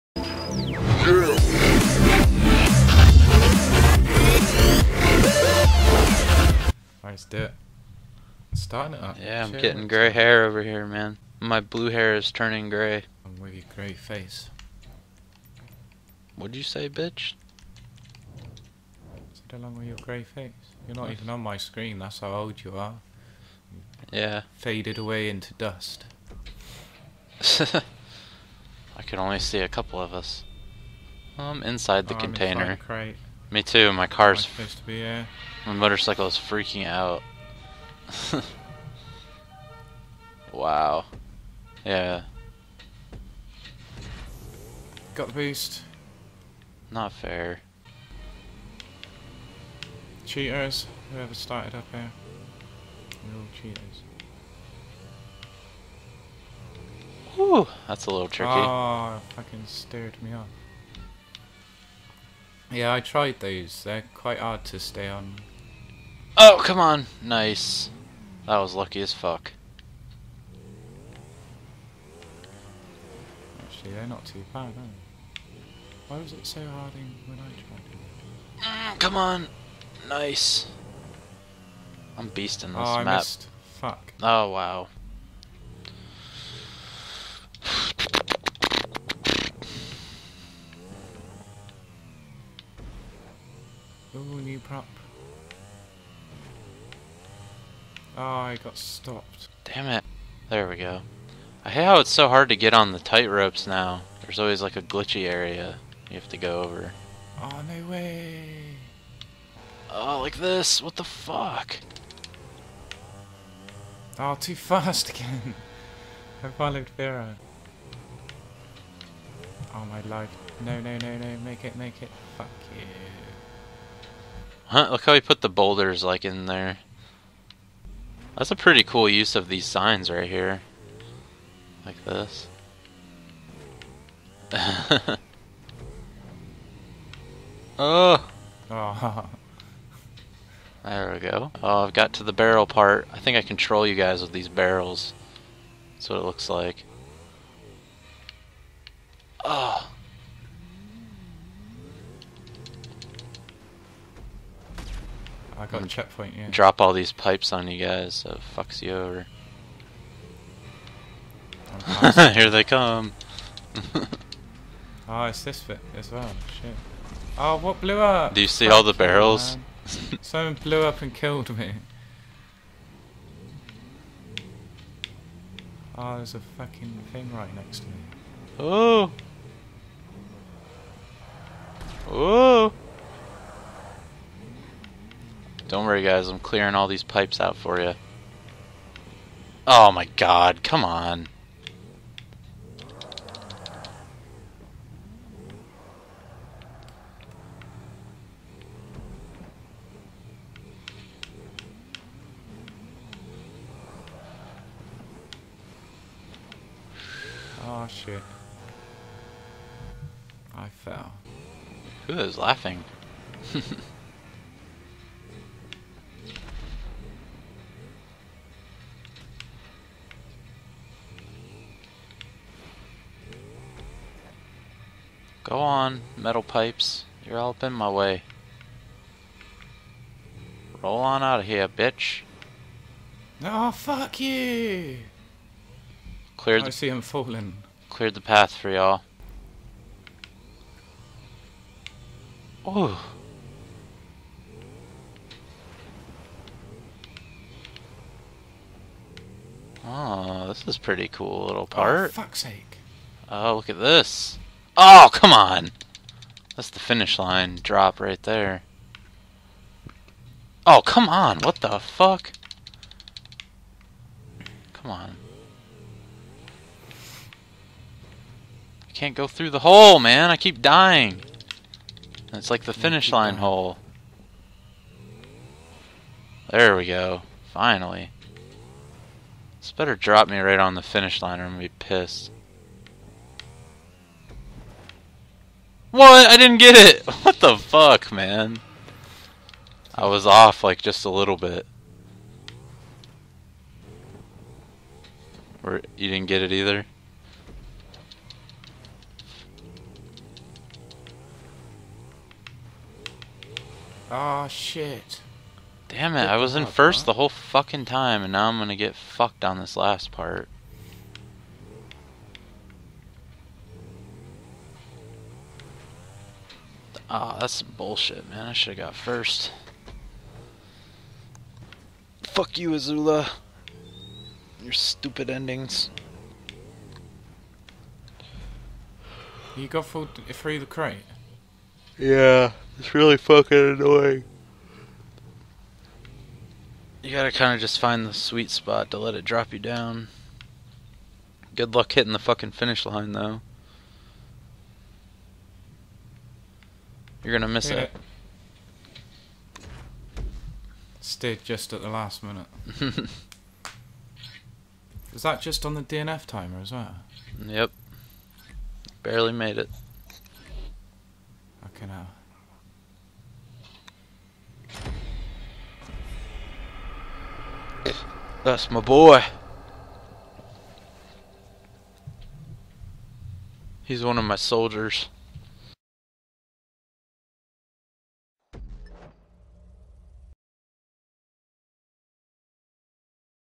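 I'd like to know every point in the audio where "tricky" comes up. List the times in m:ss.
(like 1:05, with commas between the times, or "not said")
0:58.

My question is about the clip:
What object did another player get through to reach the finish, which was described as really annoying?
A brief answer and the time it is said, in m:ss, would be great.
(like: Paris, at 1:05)
The crate, at 5:30.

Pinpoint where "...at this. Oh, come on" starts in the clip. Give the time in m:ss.
4:13.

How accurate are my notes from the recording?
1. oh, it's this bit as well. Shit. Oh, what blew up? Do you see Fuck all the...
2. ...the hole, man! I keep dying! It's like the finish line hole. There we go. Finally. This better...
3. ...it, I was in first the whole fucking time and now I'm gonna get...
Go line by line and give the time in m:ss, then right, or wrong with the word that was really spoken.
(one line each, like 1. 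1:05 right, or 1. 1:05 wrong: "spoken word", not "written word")
1. 2:45 right
2. 4:29 right
3. 5:06 right.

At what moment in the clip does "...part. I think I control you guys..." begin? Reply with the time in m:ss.
2:22.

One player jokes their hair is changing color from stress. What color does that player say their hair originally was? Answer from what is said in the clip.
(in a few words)
Blue.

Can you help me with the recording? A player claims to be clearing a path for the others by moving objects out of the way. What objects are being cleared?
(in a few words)
Metal pipes.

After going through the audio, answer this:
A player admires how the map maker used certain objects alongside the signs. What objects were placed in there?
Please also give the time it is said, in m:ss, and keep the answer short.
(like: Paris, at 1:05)
Boulders, at 2:05.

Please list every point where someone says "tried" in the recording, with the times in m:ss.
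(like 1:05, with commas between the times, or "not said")
1:03, 1:17.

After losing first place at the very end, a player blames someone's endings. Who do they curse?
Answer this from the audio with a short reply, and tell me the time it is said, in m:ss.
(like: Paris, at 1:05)
eZula, at 5:22.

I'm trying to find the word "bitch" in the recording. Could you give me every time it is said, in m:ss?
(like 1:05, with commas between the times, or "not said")
0:16, 3:51.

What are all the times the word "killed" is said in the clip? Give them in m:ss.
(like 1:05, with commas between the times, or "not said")
2:51.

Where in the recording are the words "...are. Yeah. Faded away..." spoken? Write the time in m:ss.
0:22.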